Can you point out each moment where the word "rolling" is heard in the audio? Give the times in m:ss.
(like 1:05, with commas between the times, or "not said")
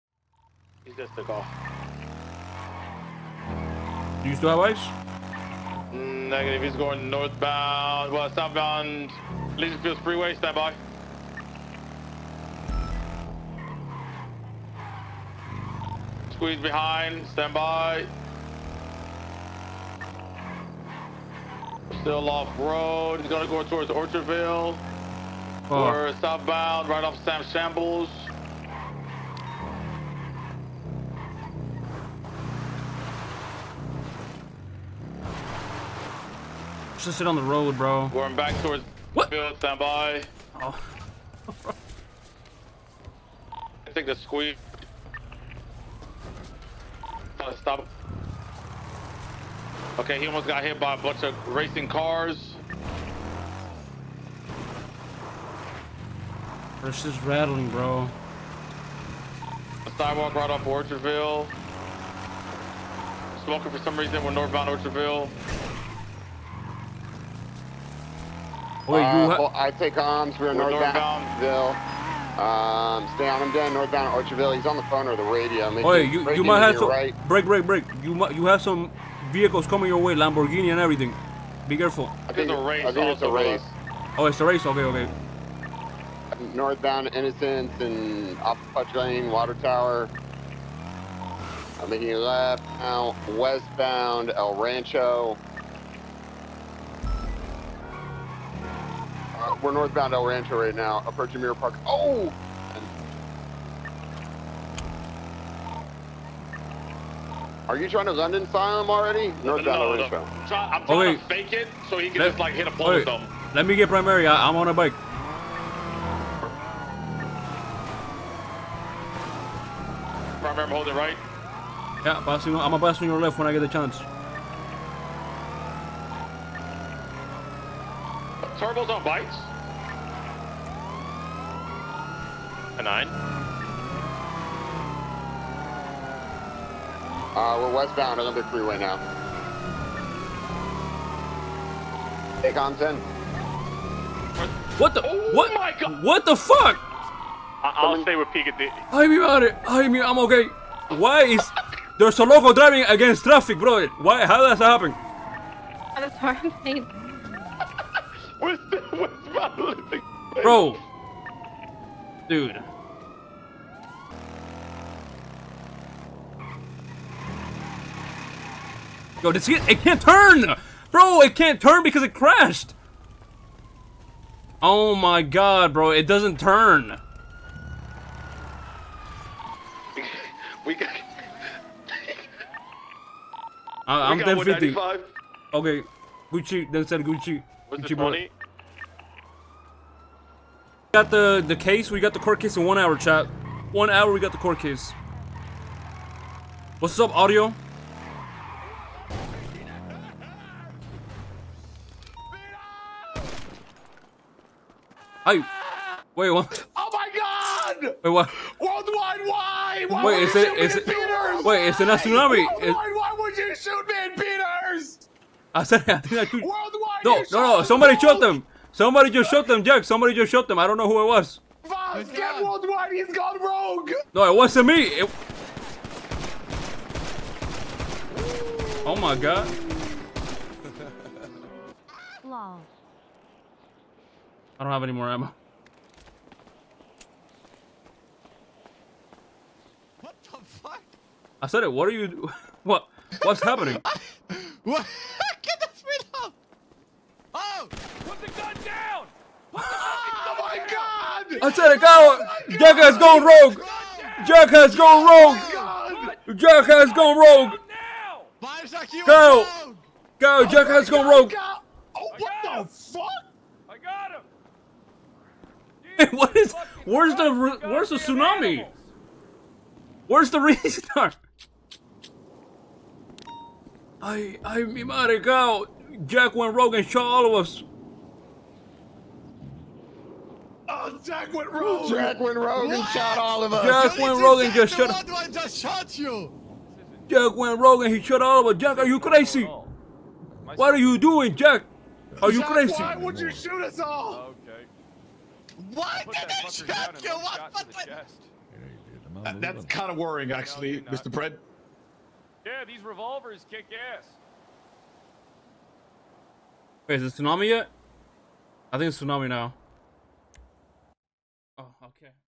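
not said.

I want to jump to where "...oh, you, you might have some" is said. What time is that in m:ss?
1:15.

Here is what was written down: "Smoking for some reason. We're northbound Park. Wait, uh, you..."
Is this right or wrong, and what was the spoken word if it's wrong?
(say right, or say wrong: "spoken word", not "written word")
wrong: "Orchardville", not "Park".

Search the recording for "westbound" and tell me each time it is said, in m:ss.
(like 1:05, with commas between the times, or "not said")
1:33, 2:17.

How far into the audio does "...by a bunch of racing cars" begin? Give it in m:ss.
0:50.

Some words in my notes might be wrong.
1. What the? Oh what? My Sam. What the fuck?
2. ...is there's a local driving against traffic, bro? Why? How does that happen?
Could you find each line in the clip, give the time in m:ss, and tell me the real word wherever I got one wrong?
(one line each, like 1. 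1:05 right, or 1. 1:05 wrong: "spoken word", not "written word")
1. 2:24 wrong: "God", not "Sam"
2. 2:31 right.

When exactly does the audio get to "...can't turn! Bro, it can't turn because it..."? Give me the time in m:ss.
2:49.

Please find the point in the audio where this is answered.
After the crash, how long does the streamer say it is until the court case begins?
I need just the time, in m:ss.
3:12.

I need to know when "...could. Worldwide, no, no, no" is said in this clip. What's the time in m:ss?
3:36.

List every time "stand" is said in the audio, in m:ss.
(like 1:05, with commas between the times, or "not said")
0:10, 0:17, 0:39.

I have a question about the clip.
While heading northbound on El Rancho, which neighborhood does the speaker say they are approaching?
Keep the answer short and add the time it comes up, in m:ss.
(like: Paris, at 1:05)
Mirror Park, at 1:41.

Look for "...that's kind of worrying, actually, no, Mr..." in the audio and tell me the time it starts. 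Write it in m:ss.
4:59.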